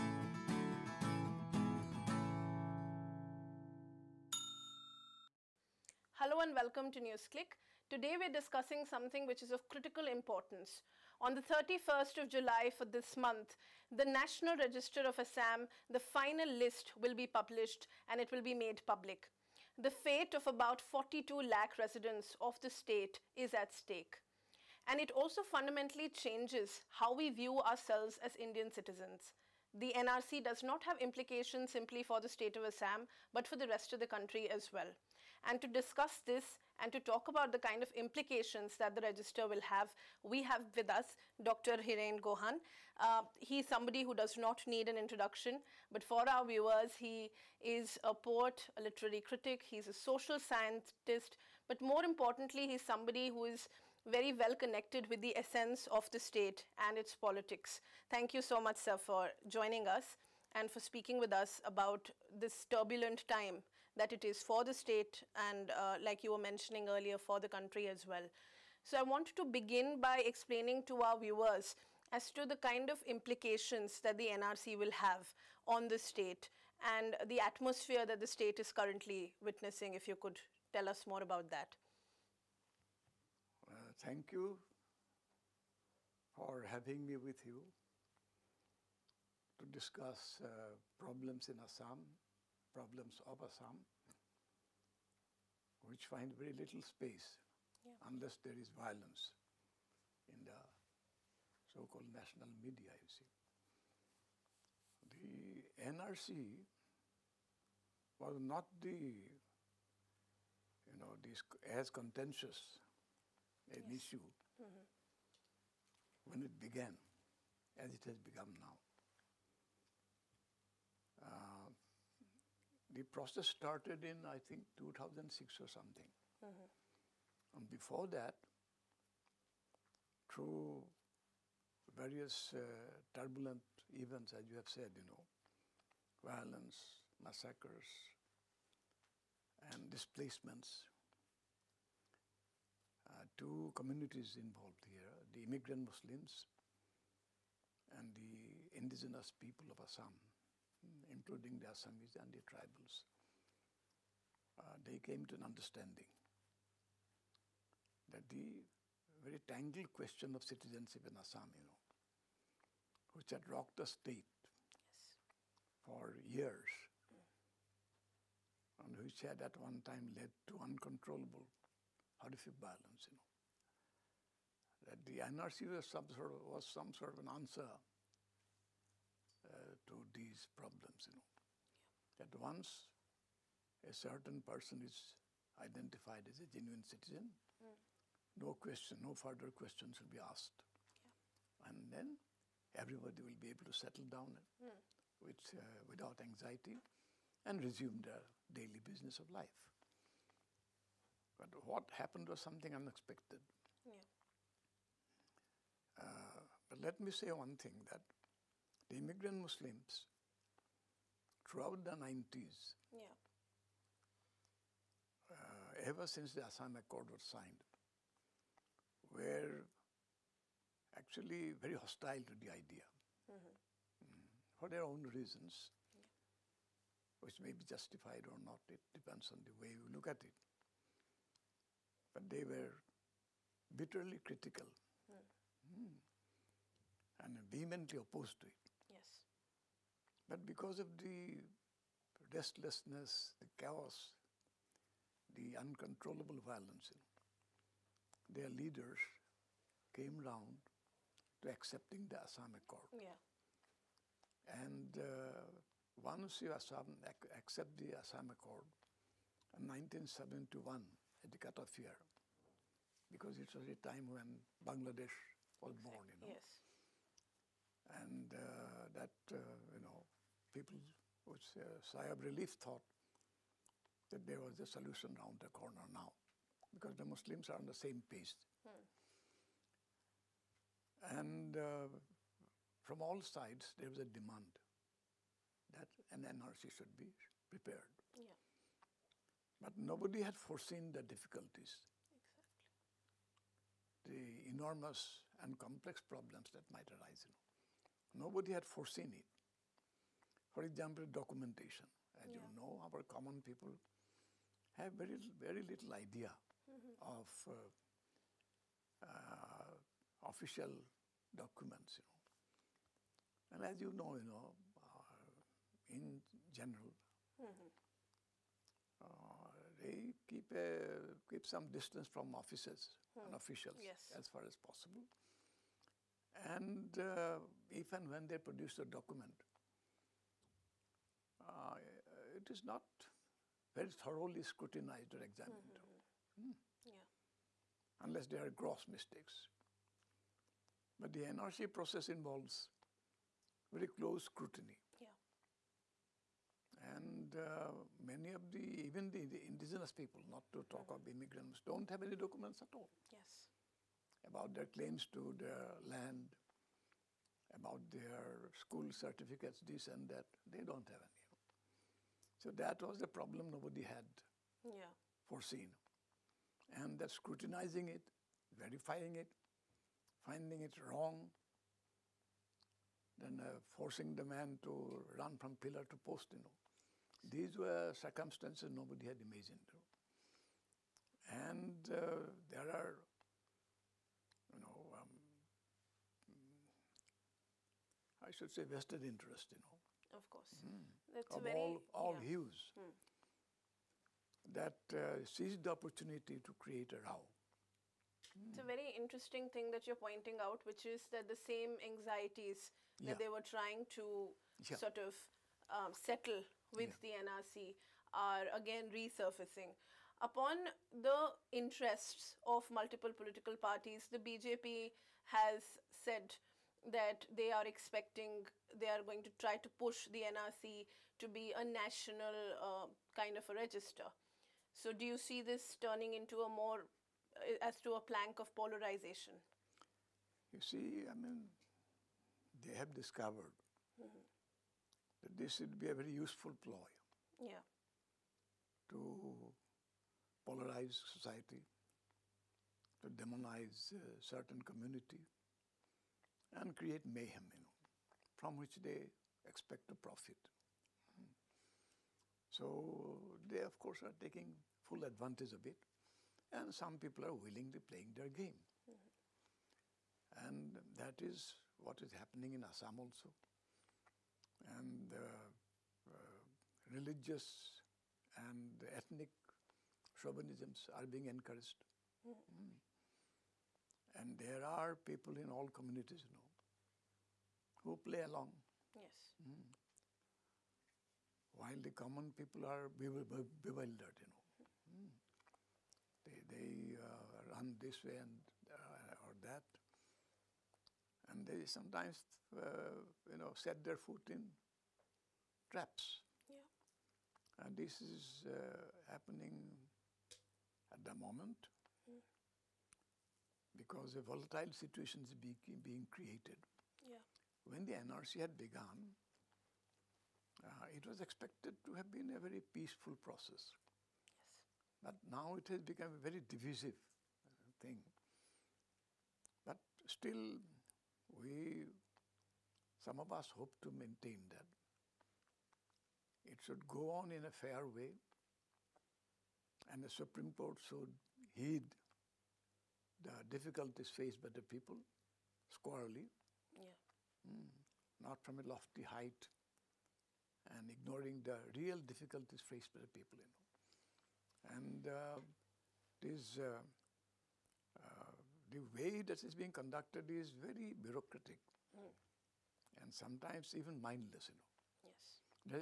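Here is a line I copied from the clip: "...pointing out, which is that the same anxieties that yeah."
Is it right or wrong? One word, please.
right.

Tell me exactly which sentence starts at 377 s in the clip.
These were circumstances nobody had imagined.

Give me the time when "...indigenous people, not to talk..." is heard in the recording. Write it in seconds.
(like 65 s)
349 s.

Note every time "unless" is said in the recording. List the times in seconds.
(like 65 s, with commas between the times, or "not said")
97 s, 337 s.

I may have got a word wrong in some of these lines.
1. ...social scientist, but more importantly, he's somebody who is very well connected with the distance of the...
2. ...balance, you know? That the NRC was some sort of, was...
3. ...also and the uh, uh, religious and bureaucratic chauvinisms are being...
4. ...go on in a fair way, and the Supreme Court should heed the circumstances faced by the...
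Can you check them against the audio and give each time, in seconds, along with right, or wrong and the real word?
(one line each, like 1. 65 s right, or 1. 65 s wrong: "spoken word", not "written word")
1. 49 s wrong: "essence", not "distance"
2. 172 s right
3. 462 s wrong: "ethnic", not "bureaucratic"
4. 526 s wrong: "difficulties", not "circumstances".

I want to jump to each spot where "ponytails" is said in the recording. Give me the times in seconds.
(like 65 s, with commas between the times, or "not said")
not said.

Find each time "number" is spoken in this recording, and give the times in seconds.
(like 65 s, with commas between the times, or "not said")
not said.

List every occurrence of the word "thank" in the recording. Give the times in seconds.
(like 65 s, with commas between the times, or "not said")
58 s, 83 s.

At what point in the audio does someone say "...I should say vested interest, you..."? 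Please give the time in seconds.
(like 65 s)
388 s.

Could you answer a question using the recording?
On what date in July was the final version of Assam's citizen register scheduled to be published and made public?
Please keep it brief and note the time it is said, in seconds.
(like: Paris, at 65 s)
31st of July, at 11 s.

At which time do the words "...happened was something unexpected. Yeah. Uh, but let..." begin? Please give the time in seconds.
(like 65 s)
201 s.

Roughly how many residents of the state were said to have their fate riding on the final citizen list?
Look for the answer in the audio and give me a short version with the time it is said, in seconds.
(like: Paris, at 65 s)
42 lakh, at 20 s.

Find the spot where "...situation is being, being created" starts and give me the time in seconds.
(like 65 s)
504 s.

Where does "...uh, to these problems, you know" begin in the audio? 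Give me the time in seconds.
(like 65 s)
179 s.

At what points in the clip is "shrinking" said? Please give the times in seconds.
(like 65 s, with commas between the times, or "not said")
not said.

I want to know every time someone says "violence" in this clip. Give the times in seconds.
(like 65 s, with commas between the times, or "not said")
98 s, 136 s, 246 s.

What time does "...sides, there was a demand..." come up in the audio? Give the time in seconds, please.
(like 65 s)
283 s.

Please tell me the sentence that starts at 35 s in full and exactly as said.
And to discuss this and to talk about the kind of implications that the register will have, we have with us Dr.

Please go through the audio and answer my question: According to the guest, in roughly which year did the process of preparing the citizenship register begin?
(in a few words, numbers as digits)
2006.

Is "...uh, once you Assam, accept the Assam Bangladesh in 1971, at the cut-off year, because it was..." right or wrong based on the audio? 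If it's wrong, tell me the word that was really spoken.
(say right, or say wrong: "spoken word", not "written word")
wrong: "Accord", not "Bangladesh".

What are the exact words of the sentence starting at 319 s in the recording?
Uh, they keep a keep some distance from officers hmm.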